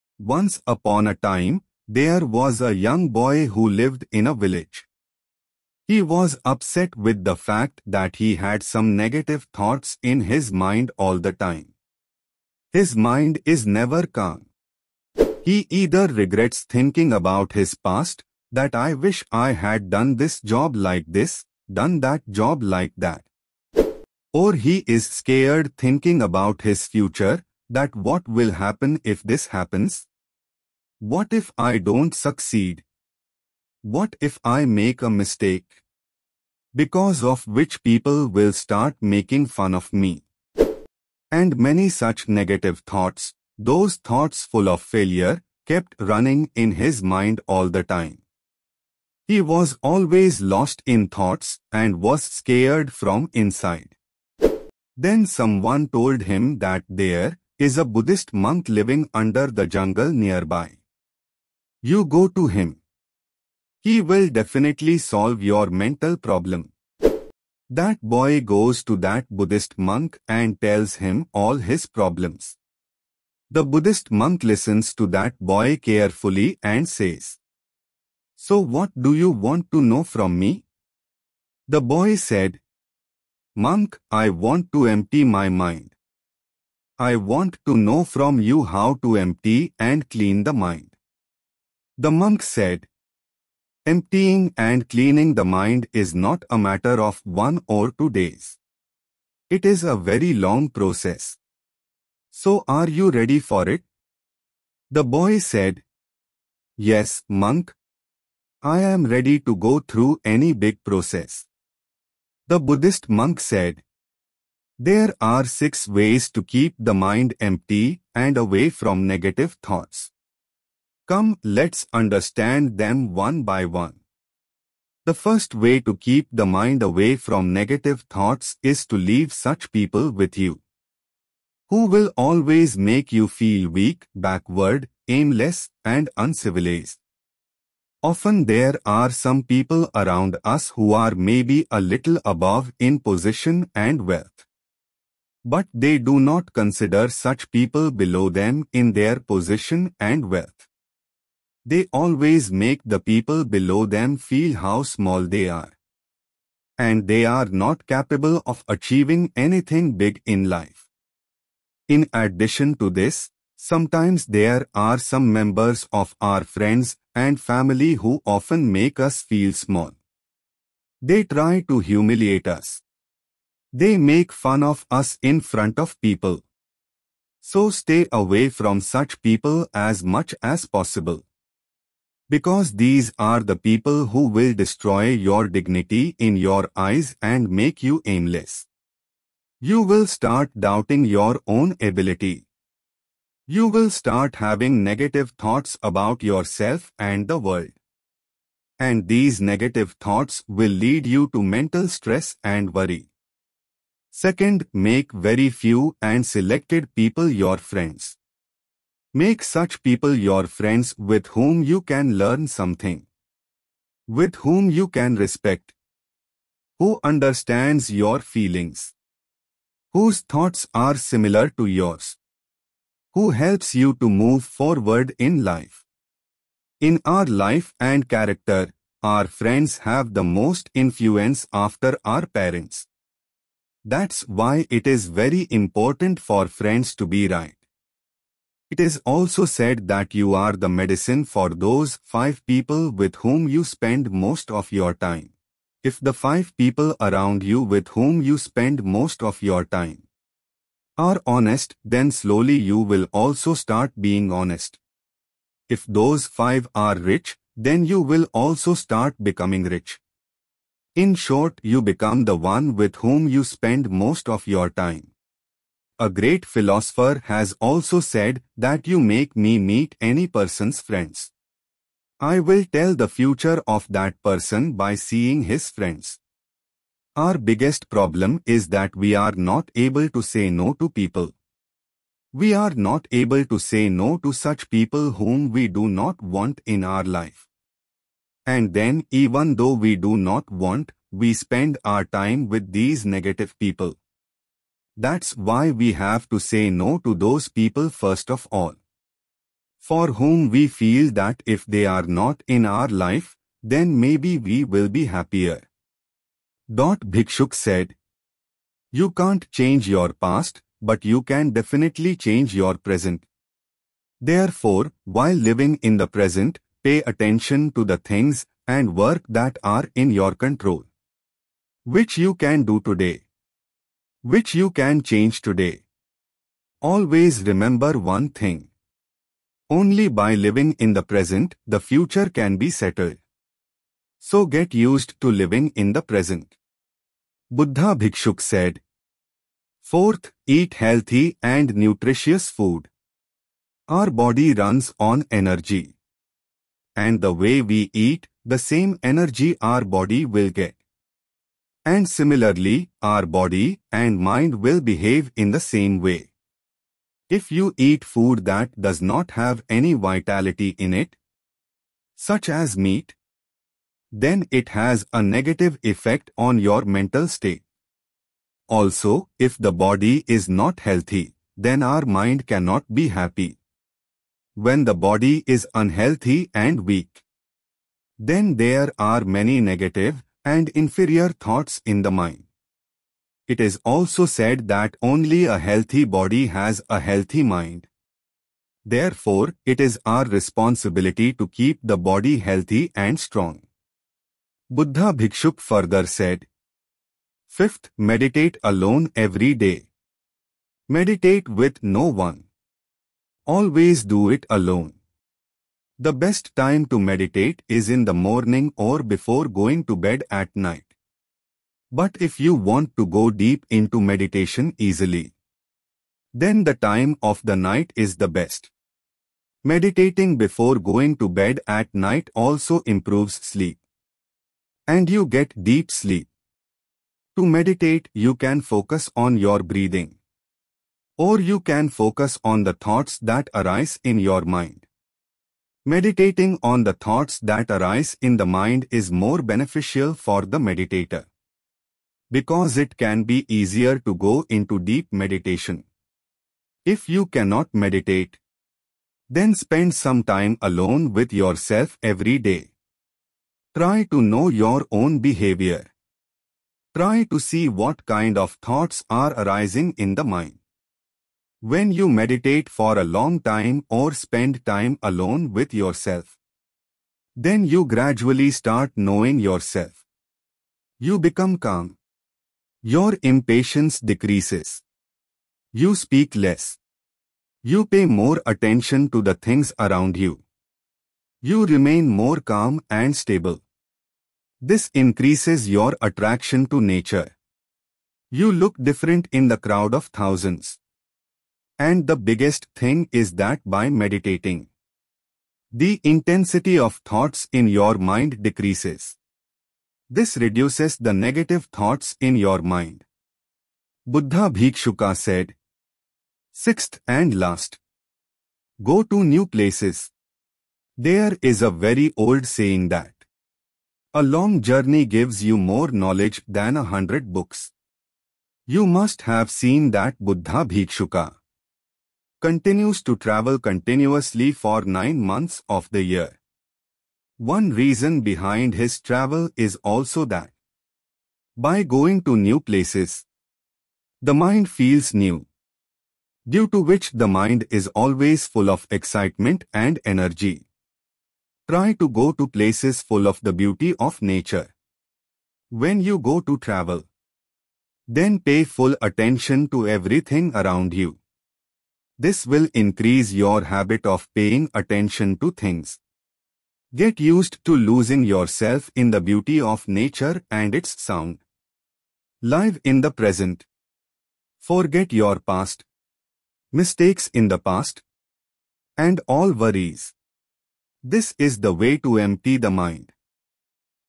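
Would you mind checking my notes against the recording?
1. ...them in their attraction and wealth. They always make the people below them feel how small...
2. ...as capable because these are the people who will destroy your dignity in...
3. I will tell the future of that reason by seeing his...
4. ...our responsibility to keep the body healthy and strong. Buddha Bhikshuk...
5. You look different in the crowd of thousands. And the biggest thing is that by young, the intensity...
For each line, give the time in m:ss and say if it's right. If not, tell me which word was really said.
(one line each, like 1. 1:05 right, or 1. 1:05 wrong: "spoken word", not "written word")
1. 2:28 wrong: "position", not "attraction"
2. 3:00 wrong: "possible", not "capable"
3. 4:32 wrong: "person", not "reason"
4. 6:30 right
5. 8:08 wrong: "meditating", not "young".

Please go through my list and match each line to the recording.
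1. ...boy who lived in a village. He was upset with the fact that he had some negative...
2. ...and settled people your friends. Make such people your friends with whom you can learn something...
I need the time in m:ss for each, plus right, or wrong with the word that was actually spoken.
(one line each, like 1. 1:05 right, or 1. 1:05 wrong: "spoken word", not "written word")
1. 0:03 right
2. 3:26 wrong: "selected", not "settled".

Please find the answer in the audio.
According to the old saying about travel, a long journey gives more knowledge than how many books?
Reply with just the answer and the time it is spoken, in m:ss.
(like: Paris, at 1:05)
100, at 8:36.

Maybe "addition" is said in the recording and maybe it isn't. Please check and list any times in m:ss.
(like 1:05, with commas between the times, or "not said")
2:42.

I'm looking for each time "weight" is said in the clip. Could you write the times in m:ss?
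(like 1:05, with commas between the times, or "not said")
not said.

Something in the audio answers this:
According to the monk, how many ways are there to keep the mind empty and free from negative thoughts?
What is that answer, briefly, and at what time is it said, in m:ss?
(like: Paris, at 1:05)
6, at 1:55.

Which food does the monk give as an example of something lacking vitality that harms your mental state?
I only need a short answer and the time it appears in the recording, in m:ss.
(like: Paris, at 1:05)
meat, at 6:02.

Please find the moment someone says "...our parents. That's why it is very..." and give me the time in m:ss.
3:52.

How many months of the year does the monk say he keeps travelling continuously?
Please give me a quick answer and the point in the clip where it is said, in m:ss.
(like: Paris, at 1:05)
9, at 8:44.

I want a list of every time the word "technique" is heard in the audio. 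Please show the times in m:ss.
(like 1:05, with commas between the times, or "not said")
not said.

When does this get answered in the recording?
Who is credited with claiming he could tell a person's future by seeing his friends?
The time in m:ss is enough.
4:26.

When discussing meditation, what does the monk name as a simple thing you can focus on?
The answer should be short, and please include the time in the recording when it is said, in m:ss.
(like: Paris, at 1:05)
breathing, at 7:09.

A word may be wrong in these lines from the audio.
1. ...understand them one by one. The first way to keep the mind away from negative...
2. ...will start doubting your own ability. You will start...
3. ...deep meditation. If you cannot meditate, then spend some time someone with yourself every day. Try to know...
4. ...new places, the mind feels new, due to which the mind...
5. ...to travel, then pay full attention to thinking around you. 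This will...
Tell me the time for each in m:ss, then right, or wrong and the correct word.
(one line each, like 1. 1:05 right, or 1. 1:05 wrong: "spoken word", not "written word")
1. 2:01 right
2. 3:09 right
3. 7:24 wrong: "alone", not "someone"
4. 8:52 right
5. 9:06 wrong: "everything", not "thinking".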